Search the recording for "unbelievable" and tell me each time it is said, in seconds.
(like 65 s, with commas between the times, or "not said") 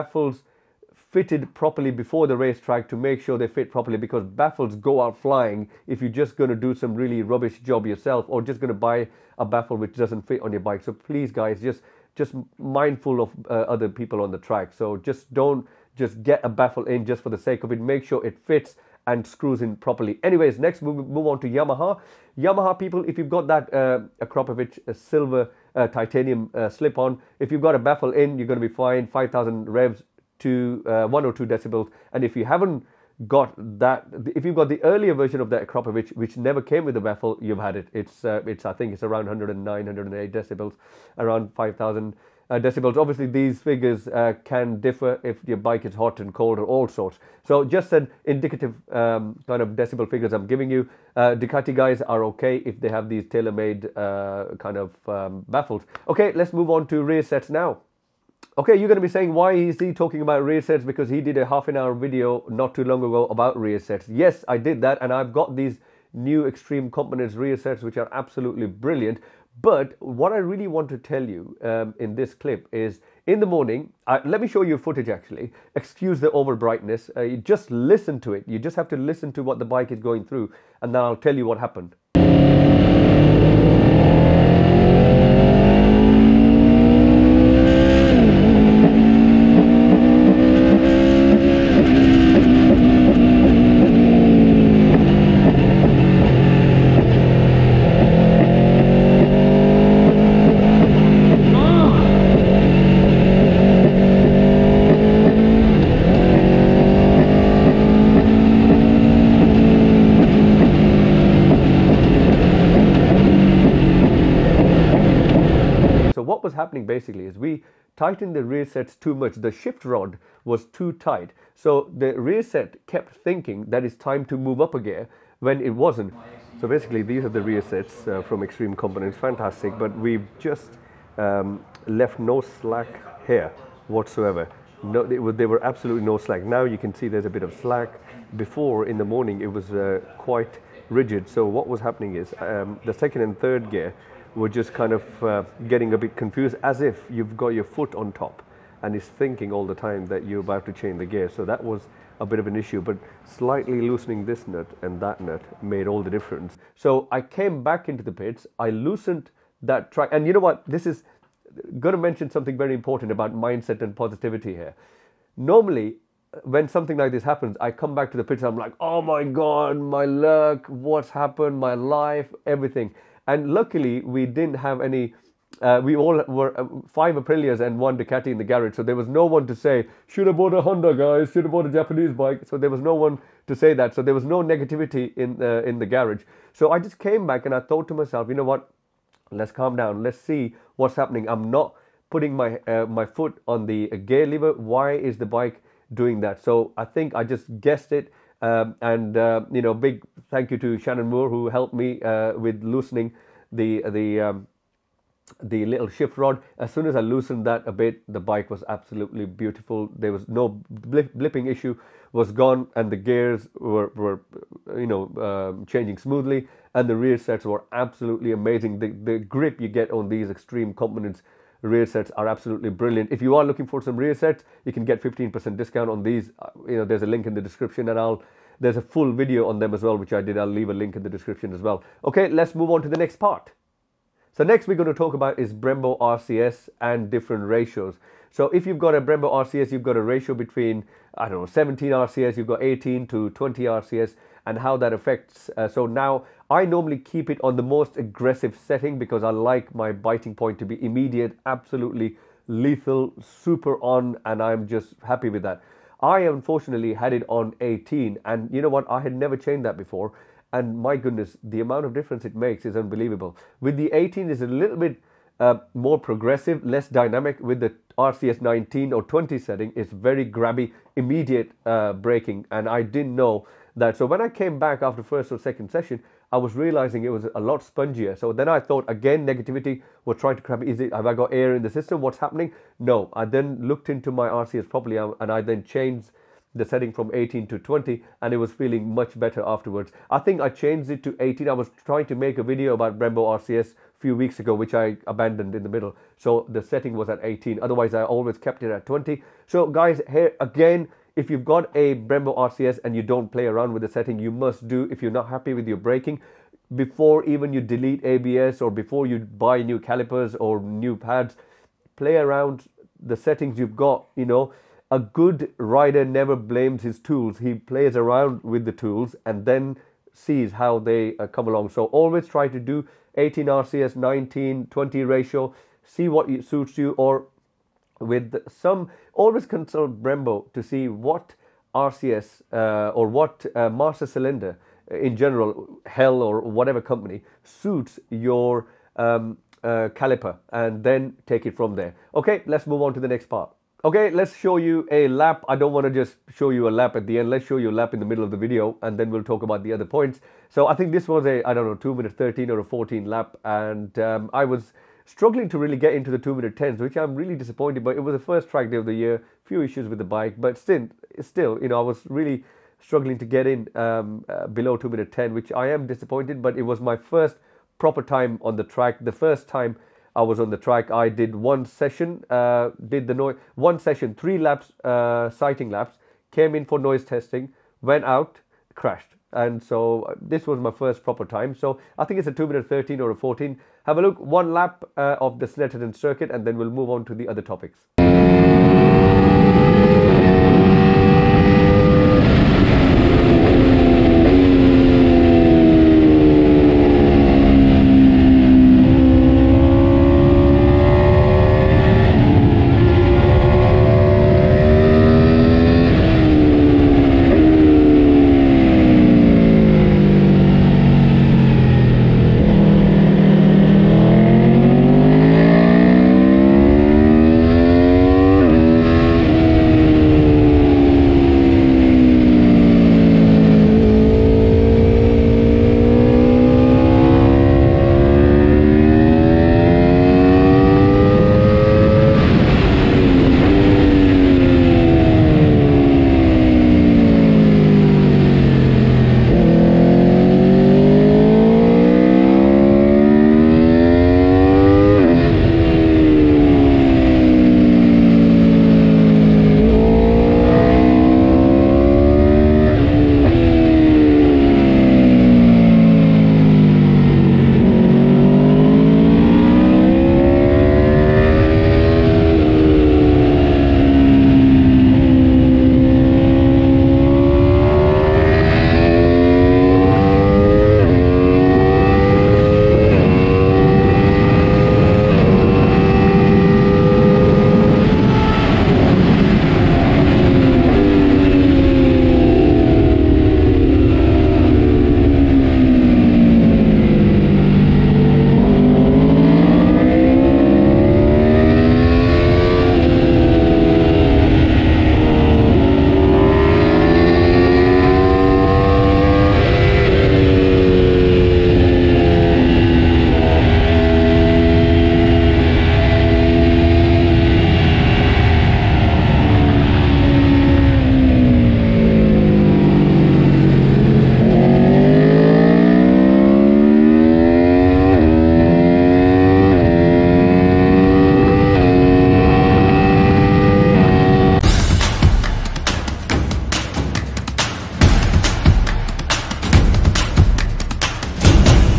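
262 s.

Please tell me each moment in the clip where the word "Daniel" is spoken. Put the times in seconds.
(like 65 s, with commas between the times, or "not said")
not said.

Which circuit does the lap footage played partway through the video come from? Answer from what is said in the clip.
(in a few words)
Snetterton.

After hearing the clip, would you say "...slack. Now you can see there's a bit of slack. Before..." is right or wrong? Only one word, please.
right.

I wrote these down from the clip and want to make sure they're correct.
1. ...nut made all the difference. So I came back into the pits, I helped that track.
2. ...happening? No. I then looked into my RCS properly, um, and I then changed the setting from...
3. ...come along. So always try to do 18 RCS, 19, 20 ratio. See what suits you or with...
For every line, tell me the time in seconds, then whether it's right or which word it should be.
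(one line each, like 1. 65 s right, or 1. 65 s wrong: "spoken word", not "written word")
1. 155 s wrong: "loosened", not "helped"
2. 282 s right
3. 321 s right.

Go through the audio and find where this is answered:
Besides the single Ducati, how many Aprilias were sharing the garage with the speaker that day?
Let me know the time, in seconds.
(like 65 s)
176 s.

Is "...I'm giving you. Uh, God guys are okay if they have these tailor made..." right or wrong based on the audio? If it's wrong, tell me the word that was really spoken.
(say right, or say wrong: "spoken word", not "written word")
wrong: "Ducati", not "God".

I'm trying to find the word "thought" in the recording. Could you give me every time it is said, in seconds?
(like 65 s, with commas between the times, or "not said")
187 s, 278 s.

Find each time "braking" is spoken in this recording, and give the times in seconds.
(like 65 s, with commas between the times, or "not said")
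271 s, 305 s.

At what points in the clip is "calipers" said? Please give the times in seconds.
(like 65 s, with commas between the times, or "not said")
309 s, 339 s.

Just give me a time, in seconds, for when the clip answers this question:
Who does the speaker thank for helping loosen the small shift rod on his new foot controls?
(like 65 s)
200 s.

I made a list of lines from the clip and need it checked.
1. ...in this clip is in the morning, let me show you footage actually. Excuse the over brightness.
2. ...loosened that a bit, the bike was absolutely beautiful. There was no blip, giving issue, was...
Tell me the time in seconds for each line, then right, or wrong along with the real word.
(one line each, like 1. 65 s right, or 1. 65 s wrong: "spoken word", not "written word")
1. 71 s right
2. 206 s wrong: "blipping", not "giving".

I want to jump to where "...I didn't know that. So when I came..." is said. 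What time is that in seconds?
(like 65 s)
272 s.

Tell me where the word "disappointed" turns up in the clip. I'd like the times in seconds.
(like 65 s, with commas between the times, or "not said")
357 s, 365 s.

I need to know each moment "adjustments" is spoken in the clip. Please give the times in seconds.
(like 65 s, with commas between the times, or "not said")
not said.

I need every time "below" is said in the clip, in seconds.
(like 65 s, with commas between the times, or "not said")
364 s.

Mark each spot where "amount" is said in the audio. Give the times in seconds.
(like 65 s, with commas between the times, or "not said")
261 s.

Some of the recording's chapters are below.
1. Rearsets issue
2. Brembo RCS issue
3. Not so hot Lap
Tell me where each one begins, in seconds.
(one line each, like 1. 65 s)
1. 57 s
2. 233 s
3. 343 s.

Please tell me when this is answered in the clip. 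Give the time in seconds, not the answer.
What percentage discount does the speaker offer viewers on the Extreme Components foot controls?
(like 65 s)
225 s.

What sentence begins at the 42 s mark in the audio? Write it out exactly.
Obviously, these figures uh, can differ if your bike is hot and cold or all sorts.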